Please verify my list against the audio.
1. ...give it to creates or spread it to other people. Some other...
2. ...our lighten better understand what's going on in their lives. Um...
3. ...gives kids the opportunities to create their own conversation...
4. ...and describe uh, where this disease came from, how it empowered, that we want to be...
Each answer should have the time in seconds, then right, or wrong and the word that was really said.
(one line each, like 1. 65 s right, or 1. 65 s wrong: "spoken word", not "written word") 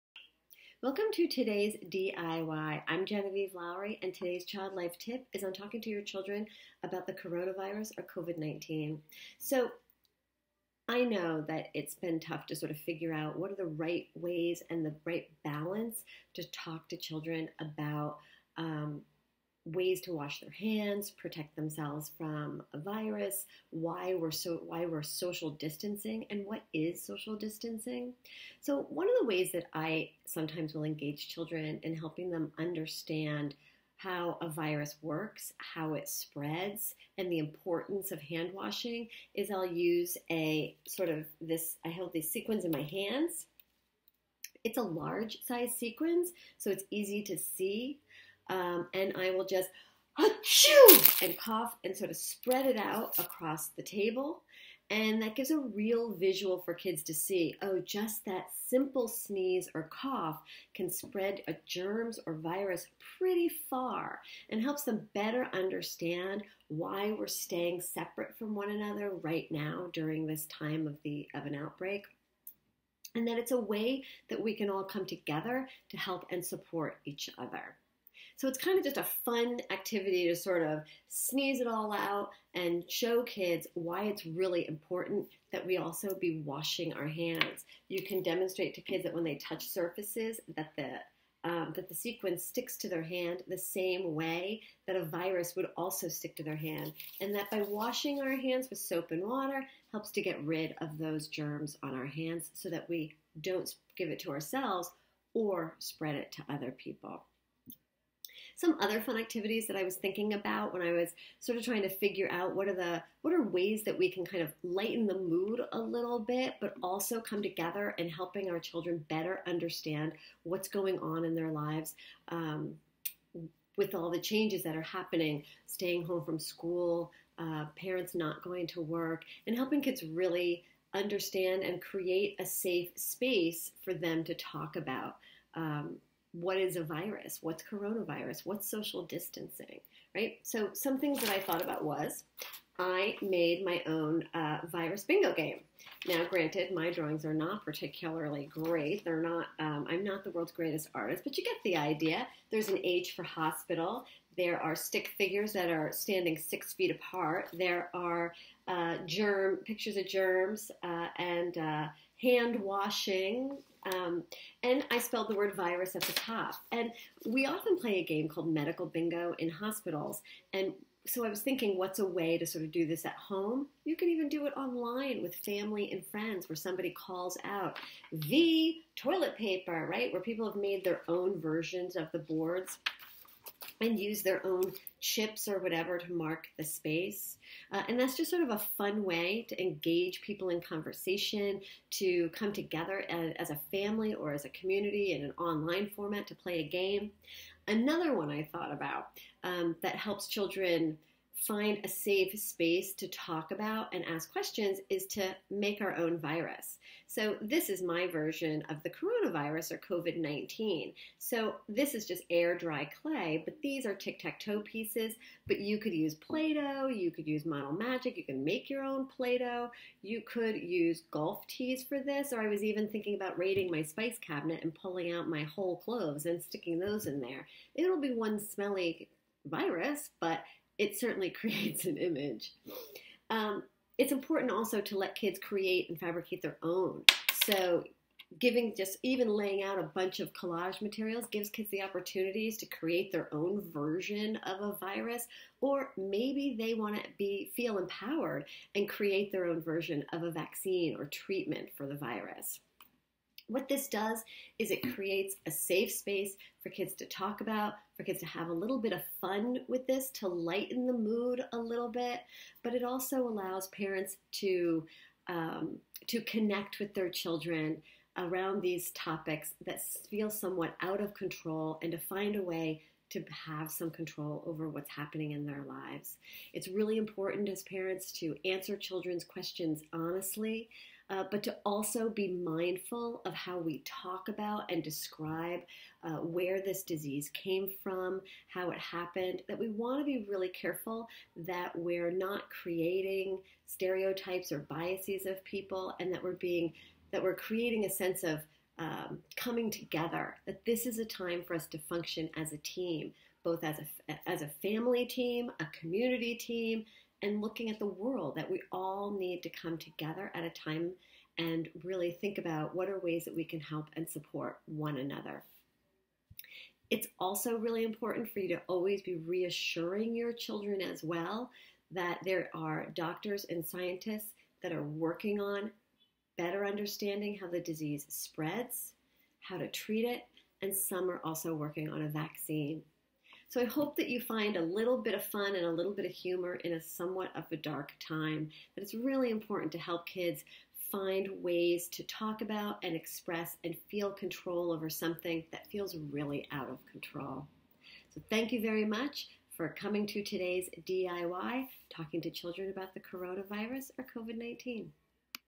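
1. 103 s wrong: "ourselves", not "creates"
2. 118 s wrong: "children", not "lighten"
3. 241 s wrong: "version", not "conversation"
4. 284 s wrong: "happened", not "empowered".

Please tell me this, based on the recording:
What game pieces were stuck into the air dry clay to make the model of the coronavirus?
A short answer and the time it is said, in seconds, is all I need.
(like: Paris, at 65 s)
Tic tac toe pieces, at 213 s.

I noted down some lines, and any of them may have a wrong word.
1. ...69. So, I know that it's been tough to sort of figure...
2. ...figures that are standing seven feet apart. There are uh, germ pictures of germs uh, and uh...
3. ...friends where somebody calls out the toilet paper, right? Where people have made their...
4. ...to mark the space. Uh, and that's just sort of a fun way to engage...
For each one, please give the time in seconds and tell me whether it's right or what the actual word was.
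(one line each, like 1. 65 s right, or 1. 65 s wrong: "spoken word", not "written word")
1. 8 s wrong: "19", not "69"
2. 155 s wrong: "six", not "seven"
3. 176 s right
4. 185 s right.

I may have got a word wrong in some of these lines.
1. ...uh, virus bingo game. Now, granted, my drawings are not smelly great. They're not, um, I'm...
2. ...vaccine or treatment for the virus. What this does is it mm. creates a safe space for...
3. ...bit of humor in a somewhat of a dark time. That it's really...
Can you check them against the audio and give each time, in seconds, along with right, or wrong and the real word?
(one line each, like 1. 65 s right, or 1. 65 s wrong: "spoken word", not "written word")
1. 144 s wrong: "particularly", not "smelly"
2. 250 s right
3. 335 s right.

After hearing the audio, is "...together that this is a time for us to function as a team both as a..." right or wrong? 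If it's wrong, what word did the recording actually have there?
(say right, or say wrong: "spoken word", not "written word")
right.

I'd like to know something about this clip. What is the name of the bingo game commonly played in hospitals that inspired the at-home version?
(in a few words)
Medical bingo.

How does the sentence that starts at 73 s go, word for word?
And that it's a way that we can all come together to help and support each other.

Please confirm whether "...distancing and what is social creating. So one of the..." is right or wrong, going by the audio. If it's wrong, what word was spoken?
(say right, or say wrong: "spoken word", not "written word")
wrong: "distancing", not "creating".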